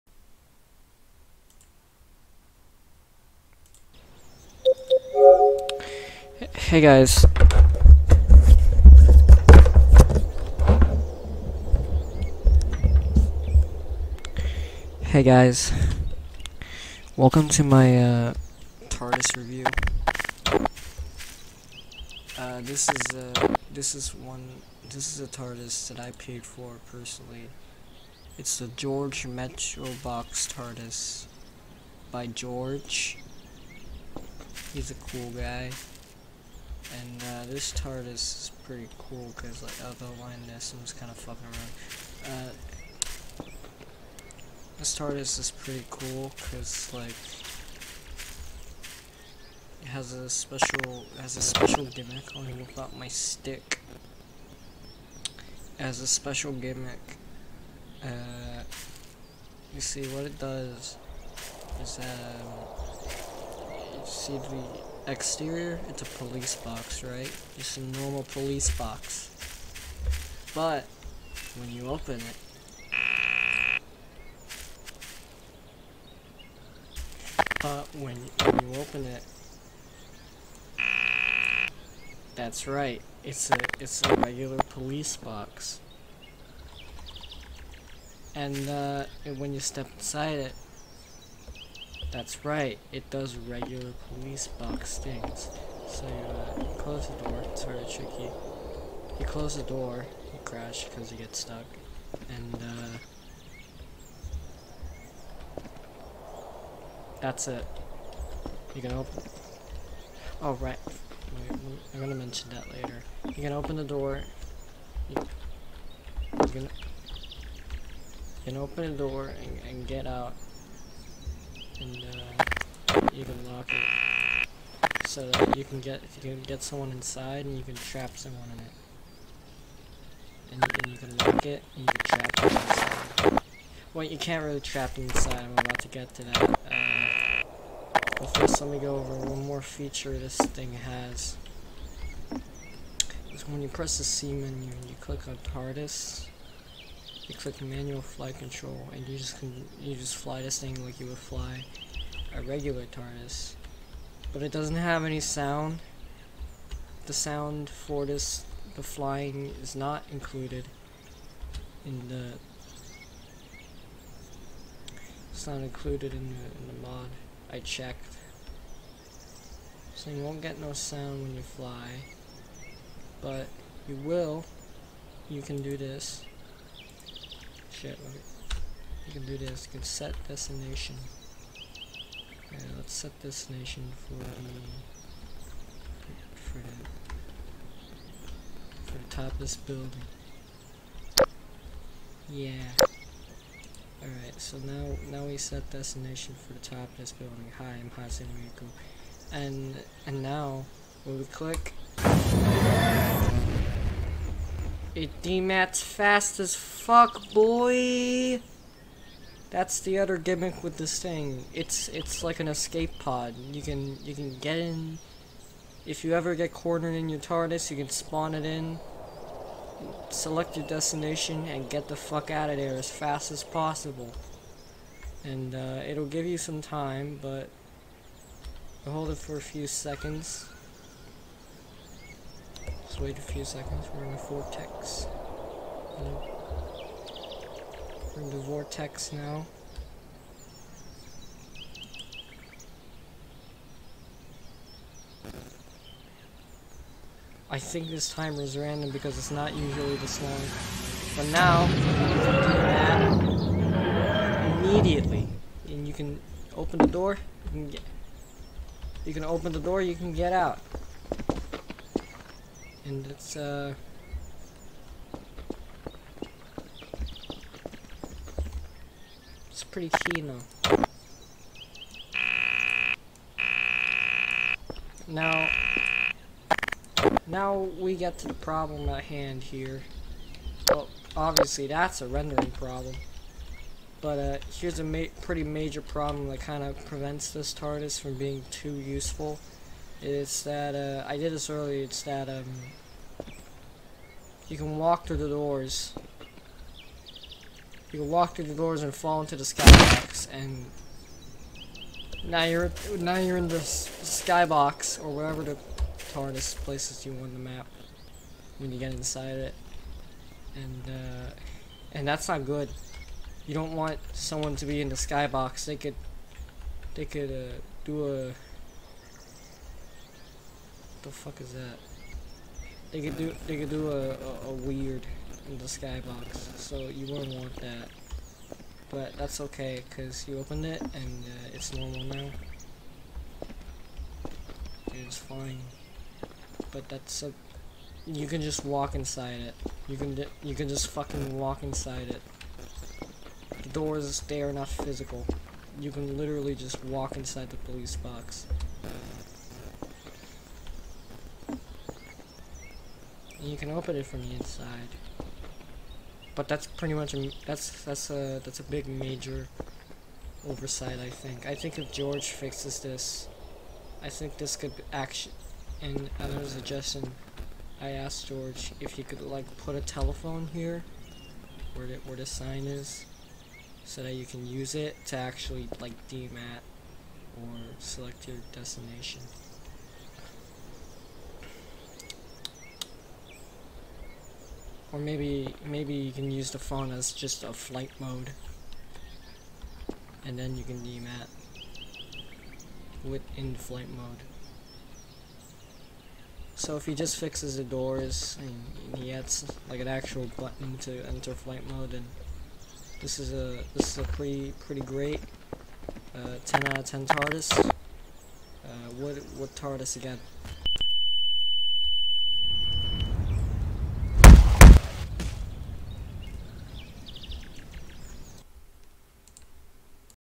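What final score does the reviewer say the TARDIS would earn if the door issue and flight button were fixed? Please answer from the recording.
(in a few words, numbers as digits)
10 out of 10.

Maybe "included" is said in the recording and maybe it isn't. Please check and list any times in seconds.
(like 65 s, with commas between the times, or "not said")
160 s, 165 s.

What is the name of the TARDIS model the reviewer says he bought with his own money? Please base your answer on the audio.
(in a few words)
Metro Box TARDIS.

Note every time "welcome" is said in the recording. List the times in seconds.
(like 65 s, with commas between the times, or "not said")
17 s.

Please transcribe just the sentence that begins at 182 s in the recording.
Okay, let's set destination for the for the for the top of this building.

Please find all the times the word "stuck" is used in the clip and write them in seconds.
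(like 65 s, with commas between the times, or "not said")
101 s.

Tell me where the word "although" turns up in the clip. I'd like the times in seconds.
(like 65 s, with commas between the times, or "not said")
39 s.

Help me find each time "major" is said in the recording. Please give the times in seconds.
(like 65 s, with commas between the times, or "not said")
285 s, 358 s.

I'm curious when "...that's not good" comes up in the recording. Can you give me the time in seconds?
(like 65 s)
312 s.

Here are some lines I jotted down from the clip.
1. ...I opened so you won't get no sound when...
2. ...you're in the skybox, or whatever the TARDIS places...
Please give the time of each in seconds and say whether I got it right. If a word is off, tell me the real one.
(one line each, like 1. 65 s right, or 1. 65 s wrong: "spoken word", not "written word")
1. 167 s wrong: "checked", not "opened"
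2. 303 s right.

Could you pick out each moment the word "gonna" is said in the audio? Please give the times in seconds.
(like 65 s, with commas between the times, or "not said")
112 s.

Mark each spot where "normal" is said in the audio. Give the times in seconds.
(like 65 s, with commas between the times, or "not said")
67 s, 331 s.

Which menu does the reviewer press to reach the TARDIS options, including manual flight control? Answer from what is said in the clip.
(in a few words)
C menu.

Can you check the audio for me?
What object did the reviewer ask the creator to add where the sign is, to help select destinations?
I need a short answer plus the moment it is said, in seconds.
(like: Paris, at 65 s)
a telephone, at 369 s.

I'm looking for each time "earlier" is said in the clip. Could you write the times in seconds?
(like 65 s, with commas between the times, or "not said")
291 s.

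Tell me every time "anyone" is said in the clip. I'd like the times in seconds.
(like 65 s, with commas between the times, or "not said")
not said.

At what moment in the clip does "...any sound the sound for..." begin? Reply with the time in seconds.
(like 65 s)
155 s.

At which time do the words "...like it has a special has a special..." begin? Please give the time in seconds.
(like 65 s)
46 s.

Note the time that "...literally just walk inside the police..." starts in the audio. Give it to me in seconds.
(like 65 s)
346 s.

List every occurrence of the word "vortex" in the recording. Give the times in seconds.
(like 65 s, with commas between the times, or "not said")
234 s, 238 s.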